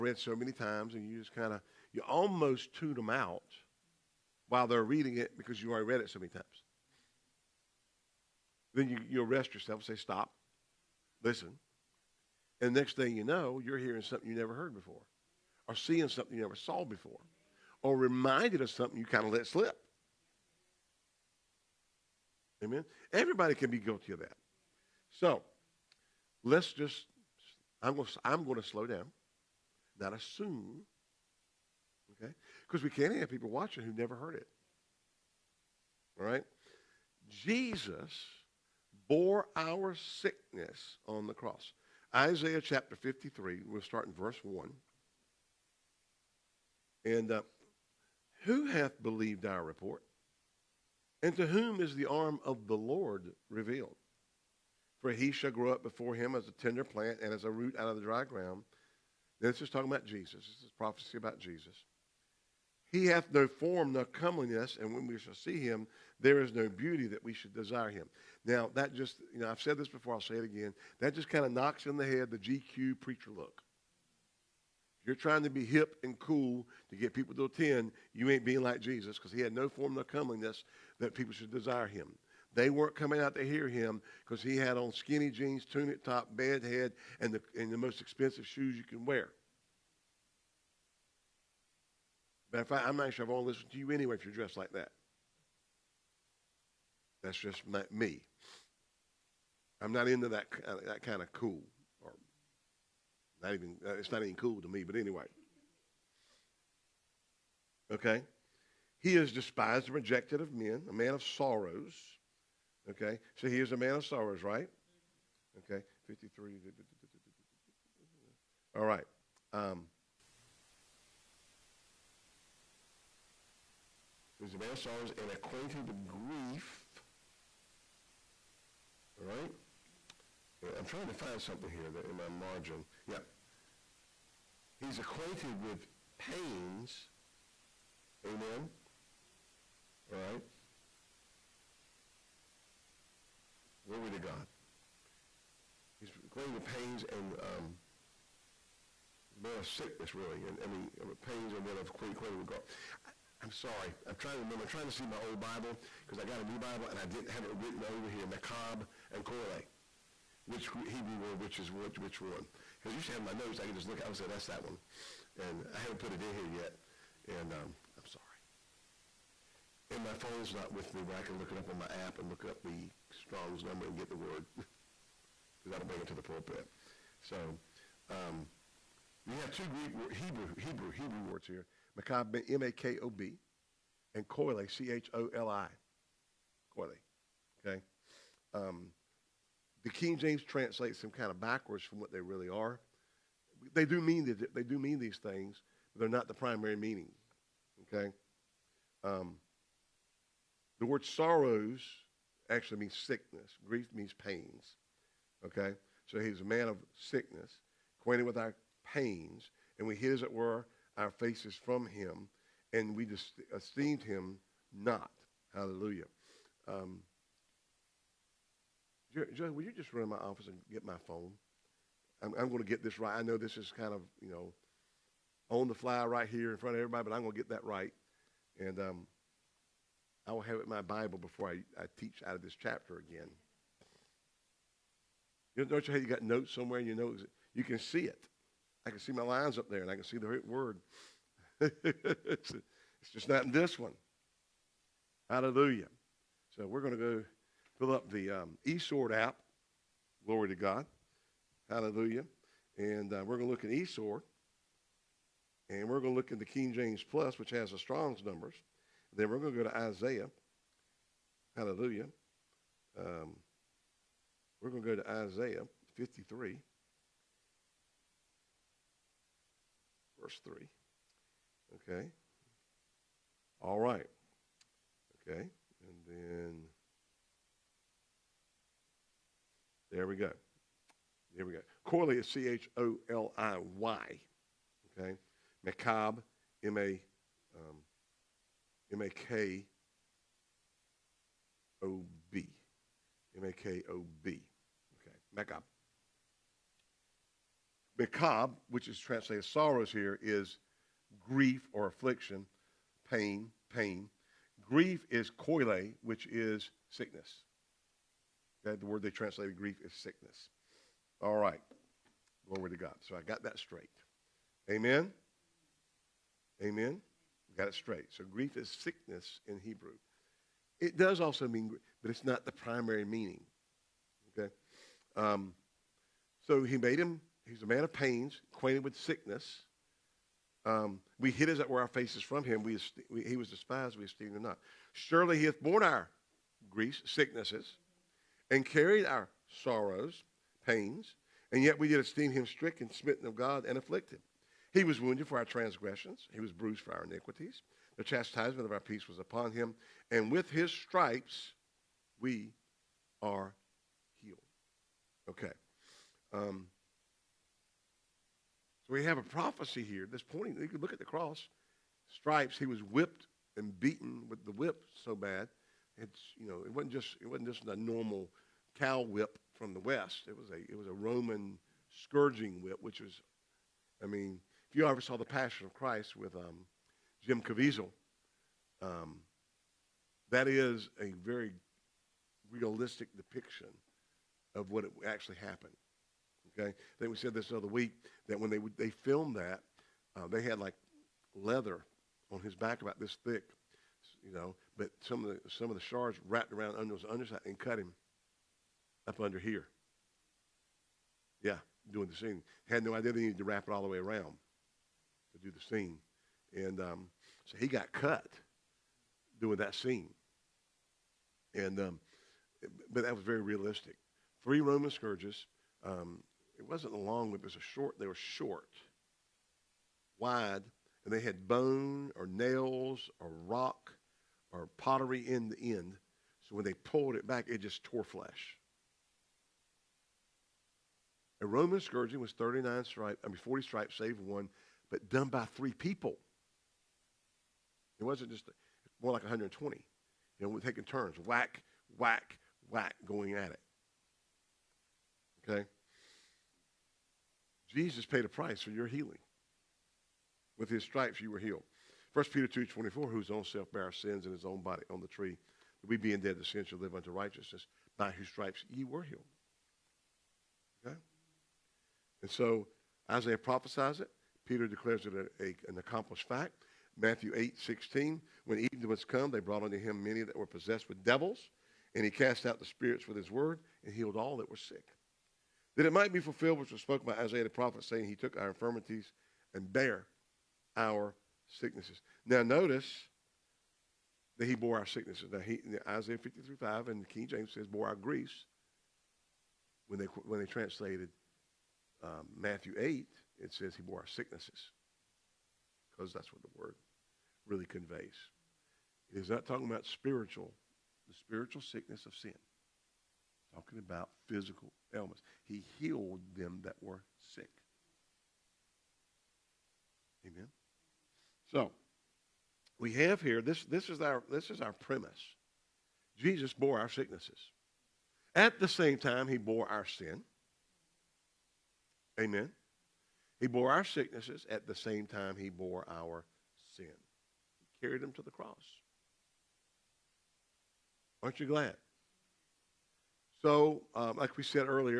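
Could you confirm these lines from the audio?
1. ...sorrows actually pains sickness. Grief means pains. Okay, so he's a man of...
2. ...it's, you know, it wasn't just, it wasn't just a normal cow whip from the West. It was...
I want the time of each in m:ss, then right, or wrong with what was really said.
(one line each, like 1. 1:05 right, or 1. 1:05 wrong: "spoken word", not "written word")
1. 3:21 wrong: "means", not "pains"
2. 6:05 right.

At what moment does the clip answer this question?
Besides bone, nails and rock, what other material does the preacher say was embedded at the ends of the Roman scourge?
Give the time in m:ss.
7:04.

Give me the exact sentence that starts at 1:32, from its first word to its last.
Matter of fact, I'm not sure I want to listen to you anyway if you're dressed like that.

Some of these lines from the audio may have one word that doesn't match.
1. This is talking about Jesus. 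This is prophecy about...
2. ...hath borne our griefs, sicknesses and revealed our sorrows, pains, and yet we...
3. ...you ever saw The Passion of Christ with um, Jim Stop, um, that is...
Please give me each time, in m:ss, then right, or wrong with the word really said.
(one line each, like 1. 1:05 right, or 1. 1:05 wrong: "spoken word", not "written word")
1. 0:59 right
2. 5:35 wrong: "carried", not "revealed"
3. 6:14 wrong: "Caviezel", not "Stop".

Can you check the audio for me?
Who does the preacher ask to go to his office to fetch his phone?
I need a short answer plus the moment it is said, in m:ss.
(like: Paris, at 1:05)
Joy, at 3:39.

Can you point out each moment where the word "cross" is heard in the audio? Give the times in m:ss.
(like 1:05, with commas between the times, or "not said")
0:41, 6:01, 8:48.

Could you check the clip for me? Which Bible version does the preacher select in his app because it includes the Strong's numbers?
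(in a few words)
King James Plus.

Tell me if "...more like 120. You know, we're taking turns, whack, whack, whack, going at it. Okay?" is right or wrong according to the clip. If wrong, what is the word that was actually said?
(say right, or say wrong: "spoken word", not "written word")
right.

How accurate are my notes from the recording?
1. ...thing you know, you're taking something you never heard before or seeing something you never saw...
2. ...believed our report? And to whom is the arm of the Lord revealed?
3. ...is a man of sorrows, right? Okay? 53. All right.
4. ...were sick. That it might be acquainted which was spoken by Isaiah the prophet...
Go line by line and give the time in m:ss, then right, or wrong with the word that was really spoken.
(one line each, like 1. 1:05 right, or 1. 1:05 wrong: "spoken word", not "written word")
1. 0:12 wrong: "hearing", not "taking"
2. 0:49 right
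3. 1:53 right
4. 7:54 wrong: "fulfilled", not "acquainted".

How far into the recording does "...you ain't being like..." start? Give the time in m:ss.
1:18.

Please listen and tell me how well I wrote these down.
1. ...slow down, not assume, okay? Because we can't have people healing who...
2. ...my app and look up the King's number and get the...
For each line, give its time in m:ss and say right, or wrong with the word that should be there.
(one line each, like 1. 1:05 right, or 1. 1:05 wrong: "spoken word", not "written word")
1. 0:28 wrong: "watching", not "healing"
2. 2:51 wrong: "Strong", not "King".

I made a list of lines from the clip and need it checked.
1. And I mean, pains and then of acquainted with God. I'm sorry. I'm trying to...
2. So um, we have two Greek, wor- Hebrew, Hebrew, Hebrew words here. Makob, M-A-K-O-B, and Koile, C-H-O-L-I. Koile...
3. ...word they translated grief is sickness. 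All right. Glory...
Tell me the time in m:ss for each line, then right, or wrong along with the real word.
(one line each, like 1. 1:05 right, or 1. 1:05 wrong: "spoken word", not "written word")
1. 2:30 right
2. 2:57 right
3. 5:08 right.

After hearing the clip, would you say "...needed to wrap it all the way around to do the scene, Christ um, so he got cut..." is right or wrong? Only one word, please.
wrong.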